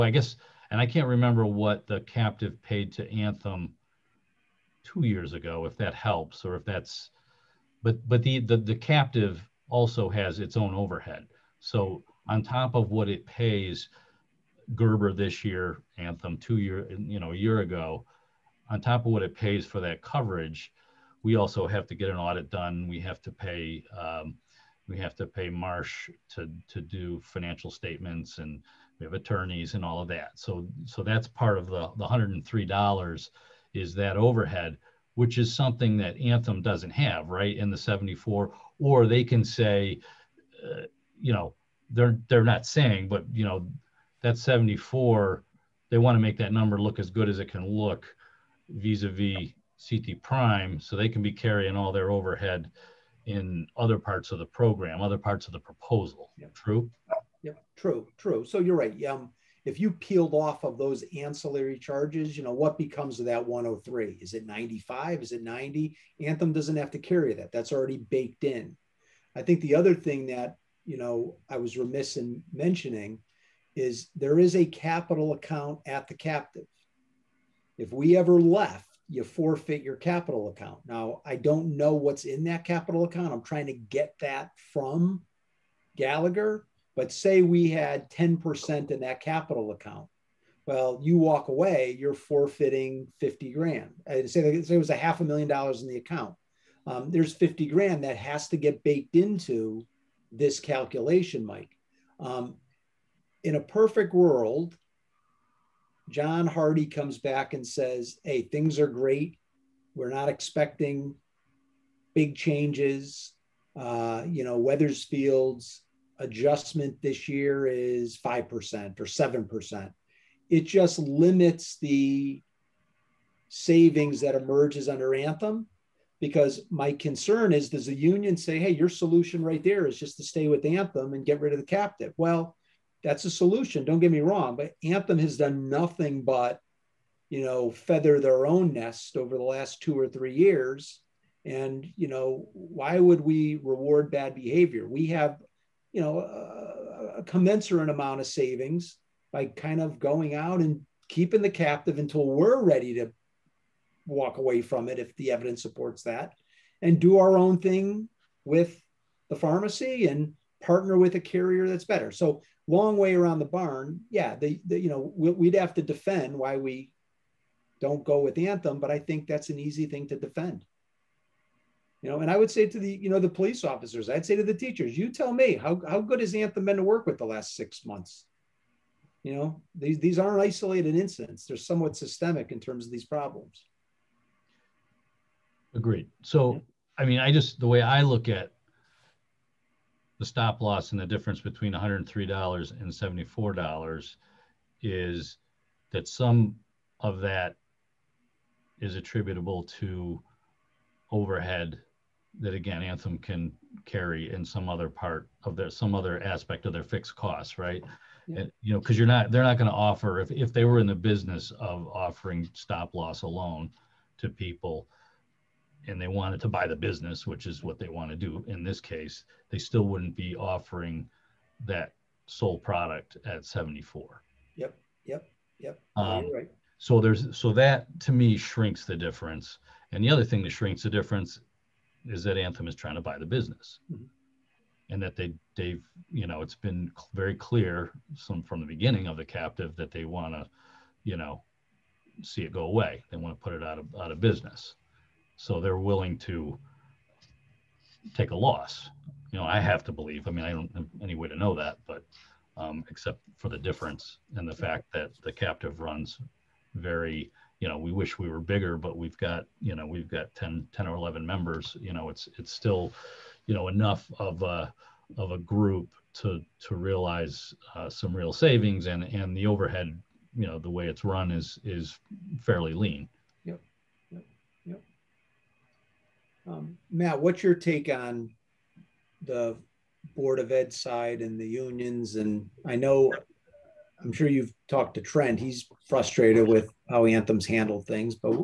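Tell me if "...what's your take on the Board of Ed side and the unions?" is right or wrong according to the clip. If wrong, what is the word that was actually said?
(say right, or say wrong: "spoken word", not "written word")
right.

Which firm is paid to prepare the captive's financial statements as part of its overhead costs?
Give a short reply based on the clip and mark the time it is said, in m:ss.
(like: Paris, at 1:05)
Marsh, at 0:25.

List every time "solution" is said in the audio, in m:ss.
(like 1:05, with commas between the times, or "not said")
2:08, 2:13.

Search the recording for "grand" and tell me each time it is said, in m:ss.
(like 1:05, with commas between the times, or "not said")
1:33, 1:37.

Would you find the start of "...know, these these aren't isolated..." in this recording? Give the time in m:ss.
2:59.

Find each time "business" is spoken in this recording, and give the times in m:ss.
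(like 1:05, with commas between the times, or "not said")
3:30, 3:36, 3:53, 4:04.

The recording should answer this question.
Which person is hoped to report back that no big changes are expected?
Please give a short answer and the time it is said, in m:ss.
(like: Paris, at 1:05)
John Hardy, at 1:46.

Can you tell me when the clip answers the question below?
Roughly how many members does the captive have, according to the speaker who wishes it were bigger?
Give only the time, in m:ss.
4:20.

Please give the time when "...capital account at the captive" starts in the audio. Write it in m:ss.
1:14.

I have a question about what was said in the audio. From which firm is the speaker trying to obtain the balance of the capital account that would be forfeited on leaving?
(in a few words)
Gallagher.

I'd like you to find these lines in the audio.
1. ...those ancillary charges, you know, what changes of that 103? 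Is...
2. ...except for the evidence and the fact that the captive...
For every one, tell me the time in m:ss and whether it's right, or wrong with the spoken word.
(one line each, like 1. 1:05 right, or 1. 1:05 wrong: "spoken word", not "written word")
1. 1:00 wrong: "becomes", not "changes"
2. 4:12 wrong: "difference", not "evidence".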